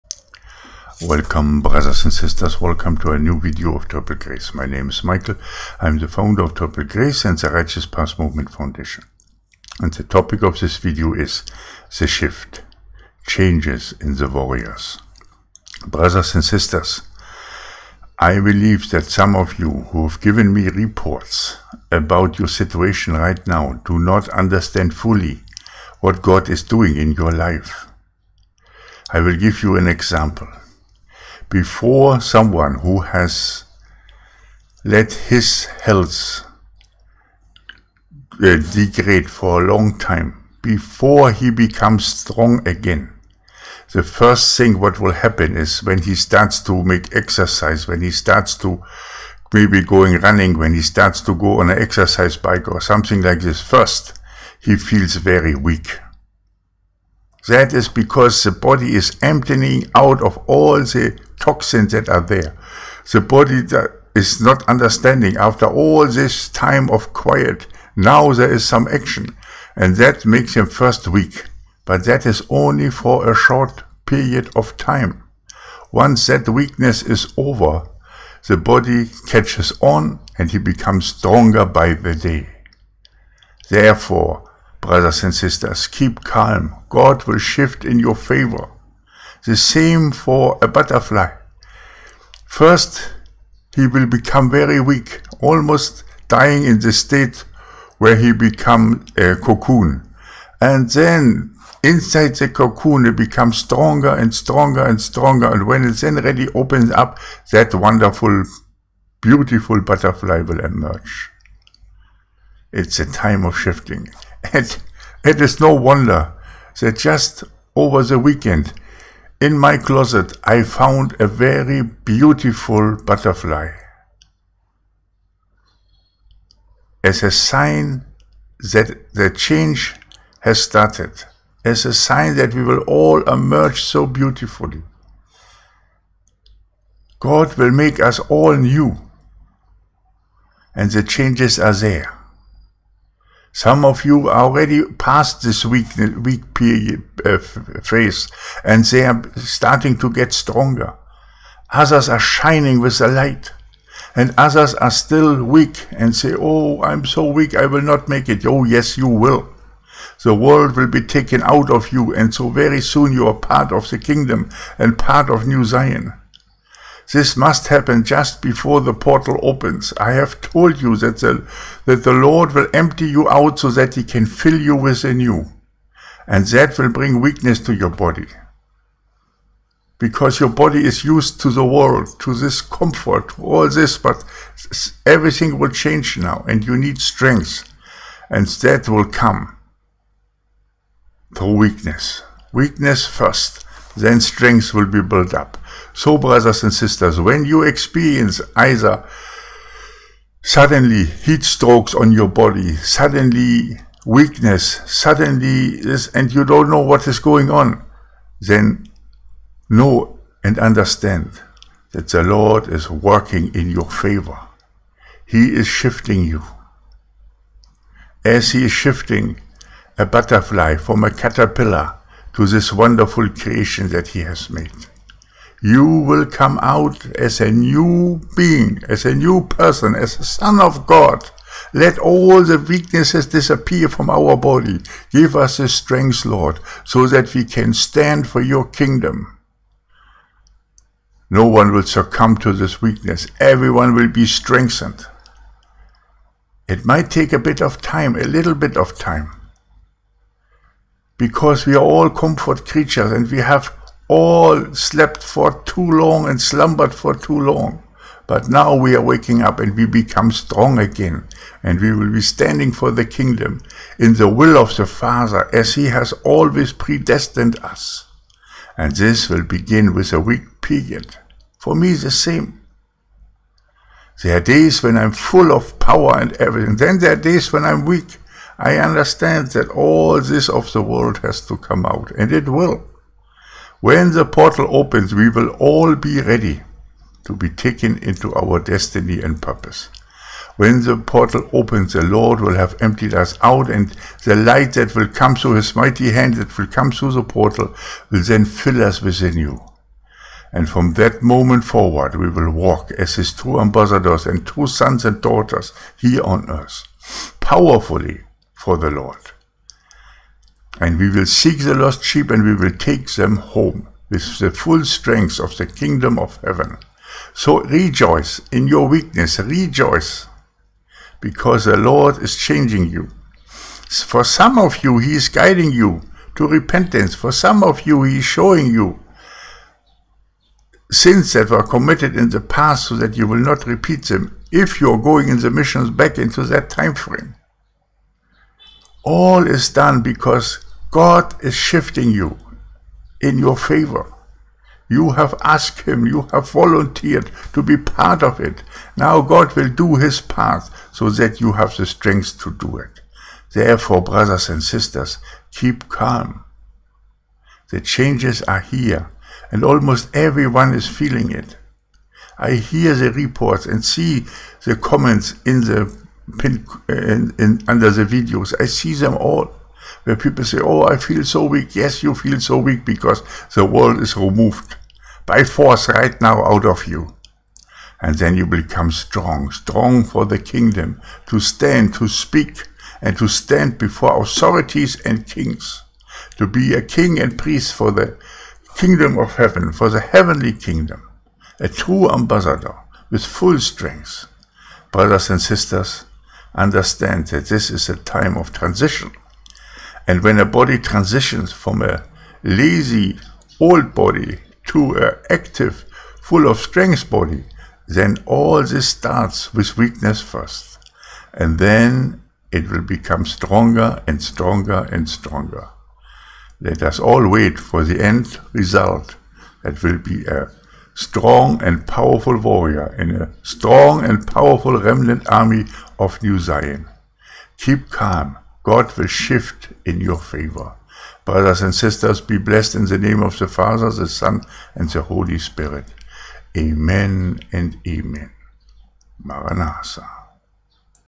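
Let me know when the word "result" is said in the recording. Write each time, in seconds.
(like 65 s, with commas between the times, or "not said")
418 s.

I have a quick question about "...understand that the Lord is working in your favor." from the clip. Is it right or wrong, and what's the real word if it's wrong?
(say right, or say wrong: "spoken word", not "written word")
right.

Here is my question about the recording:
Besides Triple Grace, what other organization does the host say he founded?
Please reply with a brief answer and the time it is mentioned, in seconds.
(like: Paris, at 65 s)
Righteous Path Movement Foundation, at 7 s.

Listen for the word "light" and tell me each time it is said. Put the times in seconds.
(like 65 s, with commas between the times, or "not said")
153 s, 294 s.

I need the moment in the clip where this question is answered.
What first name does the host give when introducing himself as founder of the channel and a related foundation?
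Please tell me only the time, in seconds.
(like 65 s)
5 s.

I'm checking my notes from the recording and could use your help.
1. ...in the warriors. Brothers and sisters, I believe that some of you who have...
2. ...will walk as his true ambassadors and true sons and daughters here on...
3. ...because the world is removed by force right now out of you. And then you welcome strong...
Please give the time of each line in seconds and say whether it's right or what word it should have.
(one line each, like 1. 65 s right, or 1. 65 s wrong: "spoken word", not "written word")
1. 13 s right
2. 302 s right
3. 372 s wrong: "become", not "welcome".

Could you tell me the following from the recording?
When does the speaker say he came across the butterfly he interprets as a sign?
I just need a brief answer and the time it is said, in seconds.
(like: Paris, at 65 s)
Over the weekend, at 117 s.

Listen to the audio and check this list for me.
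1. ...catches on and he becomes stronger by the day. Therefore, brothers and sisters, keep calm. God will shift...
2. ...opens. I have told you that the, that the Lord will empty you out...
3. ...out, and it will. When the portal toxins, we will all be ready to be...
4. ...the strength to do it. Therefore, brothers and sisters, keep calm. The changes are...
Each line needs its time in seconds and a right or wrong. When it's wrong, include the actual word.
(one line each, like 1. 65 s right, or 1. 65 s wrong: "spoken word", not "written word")
1. 79 s right
2. 169 s right
3. 281 s wrong: "opens", not "toxins"
4. 351 s right.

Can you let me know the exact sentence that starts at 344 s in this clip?
You have asked him, you have volunteered to be part of it.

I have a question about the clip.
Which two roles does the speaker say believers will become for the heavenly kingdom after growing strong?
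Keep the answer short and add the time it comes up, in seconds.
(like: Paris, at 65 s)
King and priest, at 386 s.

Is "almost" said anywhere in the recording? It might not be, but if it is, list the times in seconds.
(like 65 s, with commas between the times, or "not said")
95 s, 359 s.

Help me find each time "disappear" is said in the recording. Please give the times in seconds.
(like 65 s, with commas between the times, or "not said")
233 s.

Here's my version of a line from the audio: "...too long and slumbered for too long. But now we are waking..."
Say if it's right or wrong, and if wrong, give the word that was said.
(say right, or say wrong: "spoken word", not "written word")
right.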